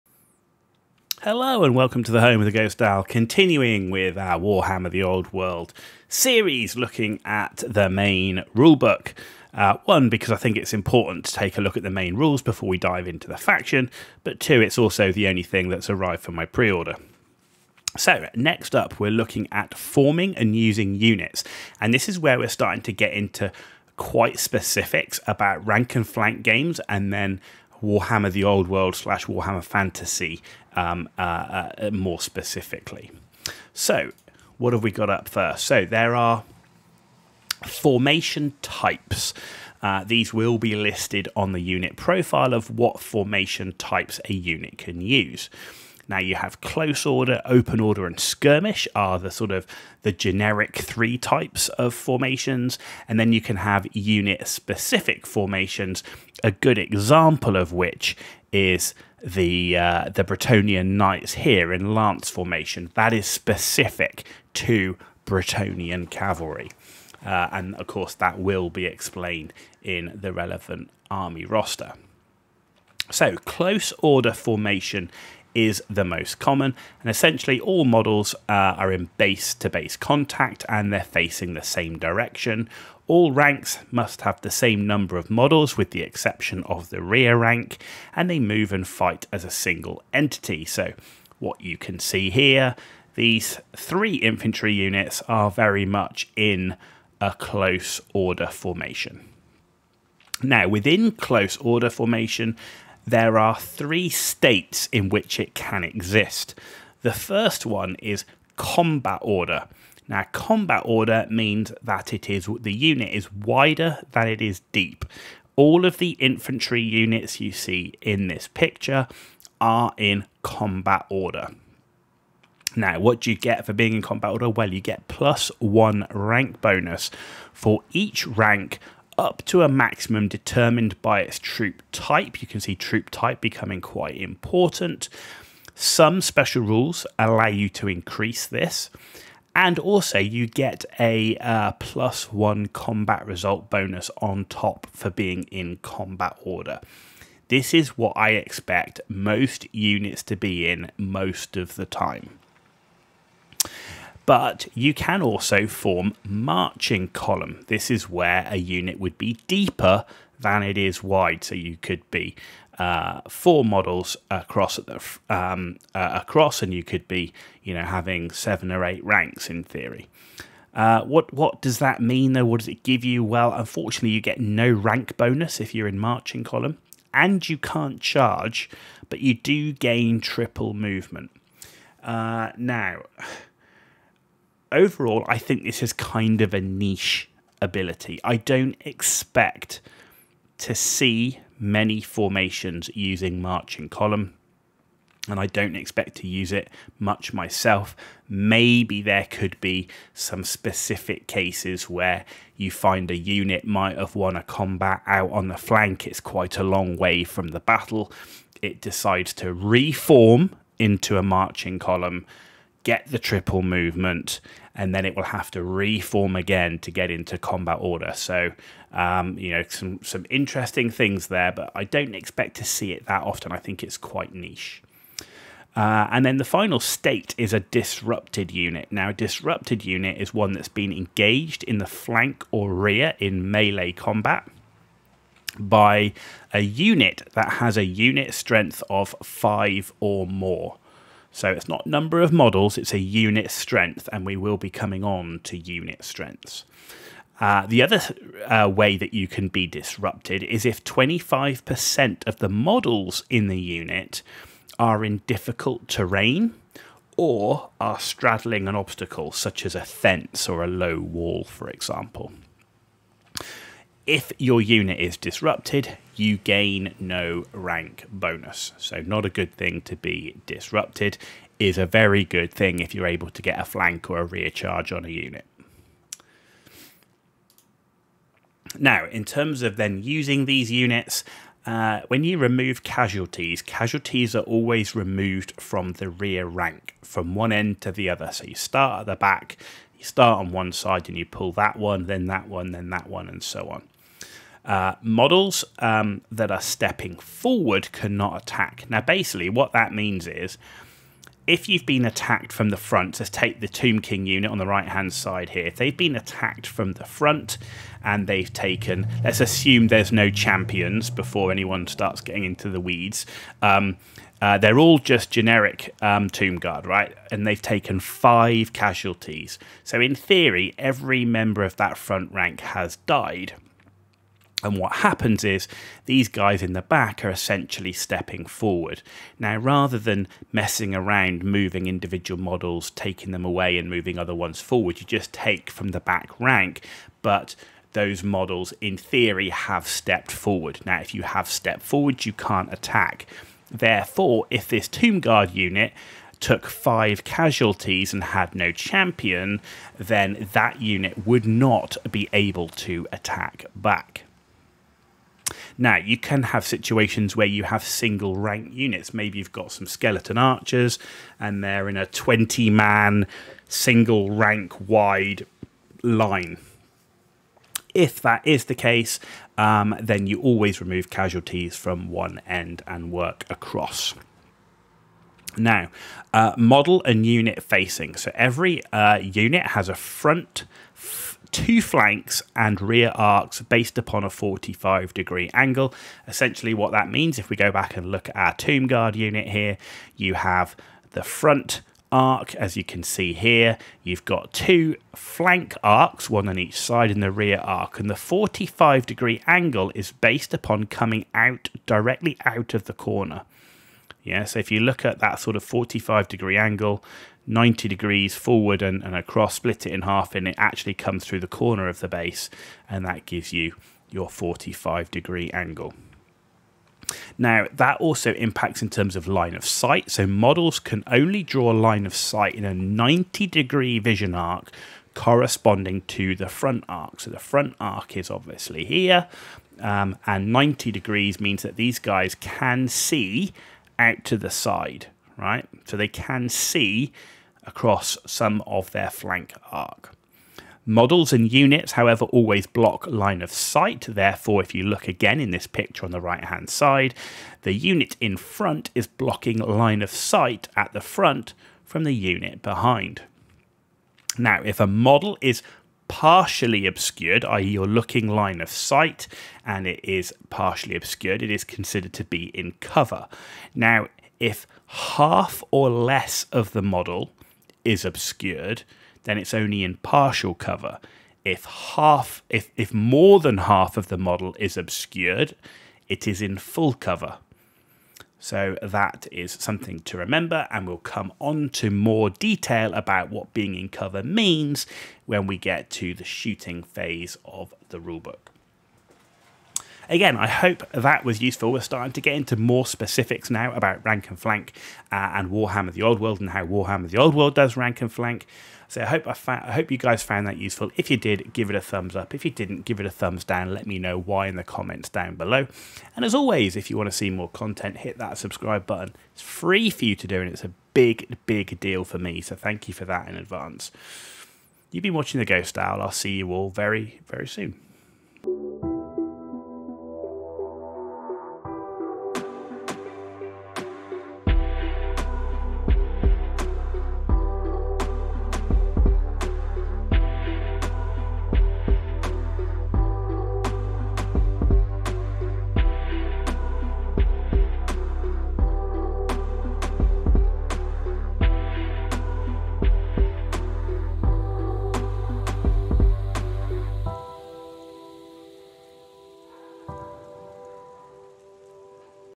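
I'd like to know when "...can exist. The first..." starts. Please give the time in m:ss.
1:45.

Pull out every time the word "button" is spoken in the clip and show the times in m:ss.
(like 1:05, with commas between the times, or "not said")
8:28.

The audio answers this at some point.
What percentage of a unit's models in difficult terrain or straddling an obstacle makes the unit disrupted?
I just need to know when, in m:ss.
4:10.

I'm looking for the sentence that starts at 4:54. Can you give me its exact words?
Uh, models um, that are stepping forward cannot attack.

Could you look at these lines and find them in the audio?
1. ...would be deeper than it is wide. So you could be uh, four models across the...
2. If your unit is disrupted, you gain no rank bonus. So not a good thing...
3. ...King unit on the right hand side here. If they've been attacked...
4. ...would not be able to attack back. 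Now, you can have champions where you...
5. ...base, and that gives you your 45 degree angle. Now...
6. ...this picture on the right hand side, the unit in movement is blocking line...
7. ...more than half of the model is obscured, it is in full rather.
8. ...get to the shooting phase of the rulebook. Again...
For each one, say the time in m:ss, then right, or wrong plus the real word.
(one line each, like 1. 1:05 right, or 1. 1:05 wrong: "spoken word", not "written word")
1. 2:38 right
2. 4:24 right
3. 5:03 right
4. 5:51 wrong: "situations", not "champions"
5. 6:52 right
6. 7:25 wrong: "front", not "movement"
7. 7:52 wrong: "cover", not "rather"
8. 8:05 right.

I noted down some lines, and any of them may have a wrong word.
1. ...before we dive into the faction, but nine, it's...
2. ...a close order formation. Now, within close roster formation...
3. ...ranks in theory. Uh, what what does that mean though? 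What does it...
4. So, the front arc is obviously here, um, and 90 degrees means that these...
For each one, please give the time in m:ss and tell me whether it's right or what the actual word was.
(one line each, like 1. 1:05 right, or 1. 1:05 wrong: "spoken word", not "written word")
1. 0:12 wrong: "two", not "nine"
2. 1:37 wrong: "order", not "roster"
3. 2:49 right
4. 7:07 right.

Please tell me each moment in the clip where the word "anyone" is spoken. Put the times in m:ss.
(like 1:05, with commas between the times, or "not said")
5:11.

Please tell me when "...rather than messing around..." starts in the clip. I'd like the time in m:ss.
5:29.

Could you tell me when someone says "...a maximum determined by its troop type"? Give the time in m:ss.
2:09.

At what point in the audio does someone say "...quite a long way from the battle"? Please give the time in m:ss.
3:26.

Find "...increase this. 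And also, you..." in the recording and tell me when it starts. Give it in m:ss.
2:17.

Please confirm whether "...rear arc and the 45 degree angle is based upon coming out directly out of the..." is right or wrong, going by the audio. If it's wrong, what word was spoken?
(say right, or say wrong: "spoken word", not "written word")
right.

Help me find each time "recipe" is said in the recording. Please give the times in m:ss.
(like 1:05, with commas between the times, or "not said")
not said.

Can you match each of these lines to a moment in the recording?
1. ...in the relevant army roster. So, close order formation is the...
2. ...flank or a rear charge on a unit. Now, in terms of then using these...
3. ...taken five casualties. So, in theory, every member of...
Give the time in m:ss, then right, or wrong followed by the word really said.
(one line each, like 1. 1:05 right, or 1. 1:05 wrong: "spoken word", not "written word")
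1. 1:09 right
2. 4:33 right
3. 5:17 right.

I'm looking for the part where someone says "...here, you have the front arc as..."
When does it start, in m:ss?
6:29.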